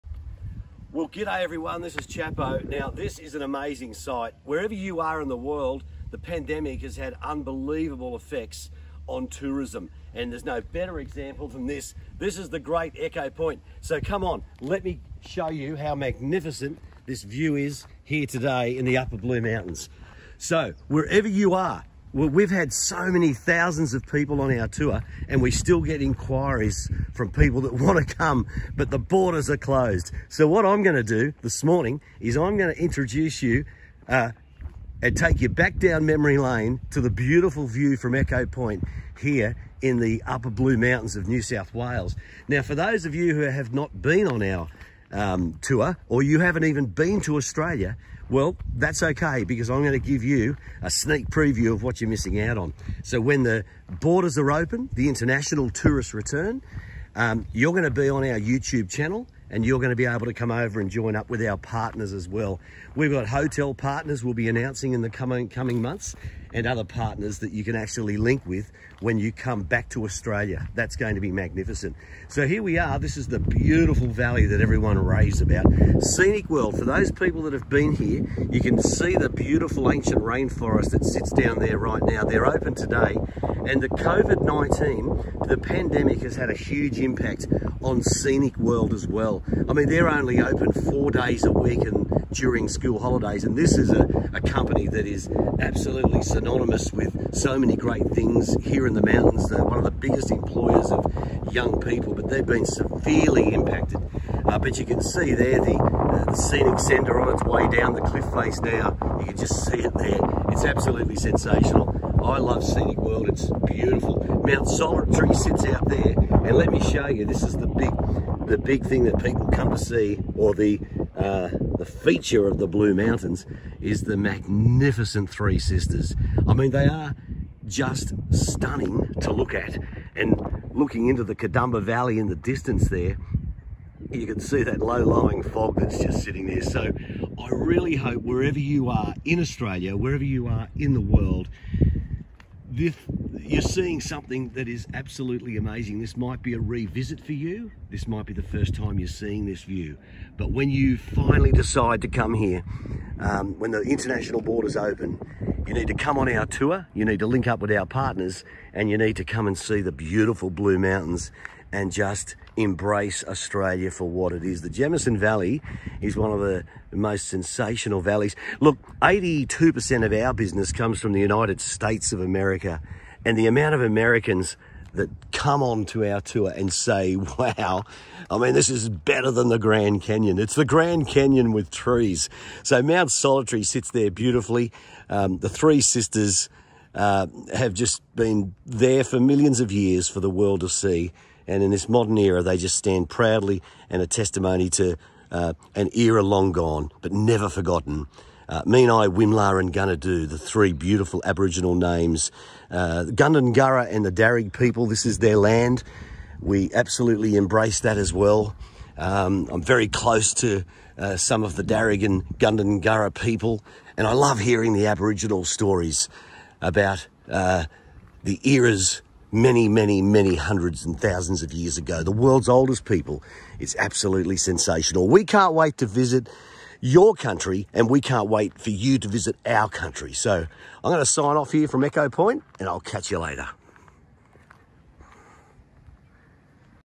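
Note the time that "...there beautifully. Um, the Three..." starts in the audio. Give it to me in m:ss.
3:03.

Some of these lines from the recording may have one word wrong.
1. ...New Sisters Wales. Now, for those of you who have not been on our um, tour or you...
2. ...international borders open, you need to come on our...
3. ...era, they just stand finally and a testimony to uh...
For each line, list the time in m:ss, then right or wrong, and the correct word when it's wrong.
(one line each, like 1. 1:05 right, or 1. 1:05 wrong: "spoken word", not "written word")
1. 0:41 wrong: "South", not "Sisters"
2. 2:33 right
3. 3:12 wrong: "proudly", not "finally".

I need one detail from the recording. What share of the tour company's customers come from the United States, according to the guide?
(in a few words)
82%.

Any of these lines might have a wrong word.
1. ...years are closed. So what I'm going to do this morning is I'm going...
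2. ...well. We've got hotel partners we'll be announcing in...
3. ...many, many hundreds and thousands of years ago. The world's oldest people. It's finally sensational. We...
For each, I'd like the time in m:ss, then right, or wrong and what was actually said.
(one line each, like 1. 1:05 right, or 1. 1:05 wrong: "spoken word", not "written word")
1. 0:28 wrong: "borders", not "years"
2. 1:02 right
3. 3:39 wrong: "absolutely", not "finally".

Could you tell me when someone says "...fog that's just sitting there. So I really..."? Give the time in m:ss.
2:15.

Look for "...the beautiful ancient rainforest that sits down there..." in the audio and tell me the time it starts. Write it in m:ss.
1:19.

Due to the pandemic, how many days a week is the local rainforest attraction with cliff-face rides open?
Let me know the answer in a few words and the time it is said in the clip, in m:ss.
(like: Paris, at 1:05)
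4, at 1:30.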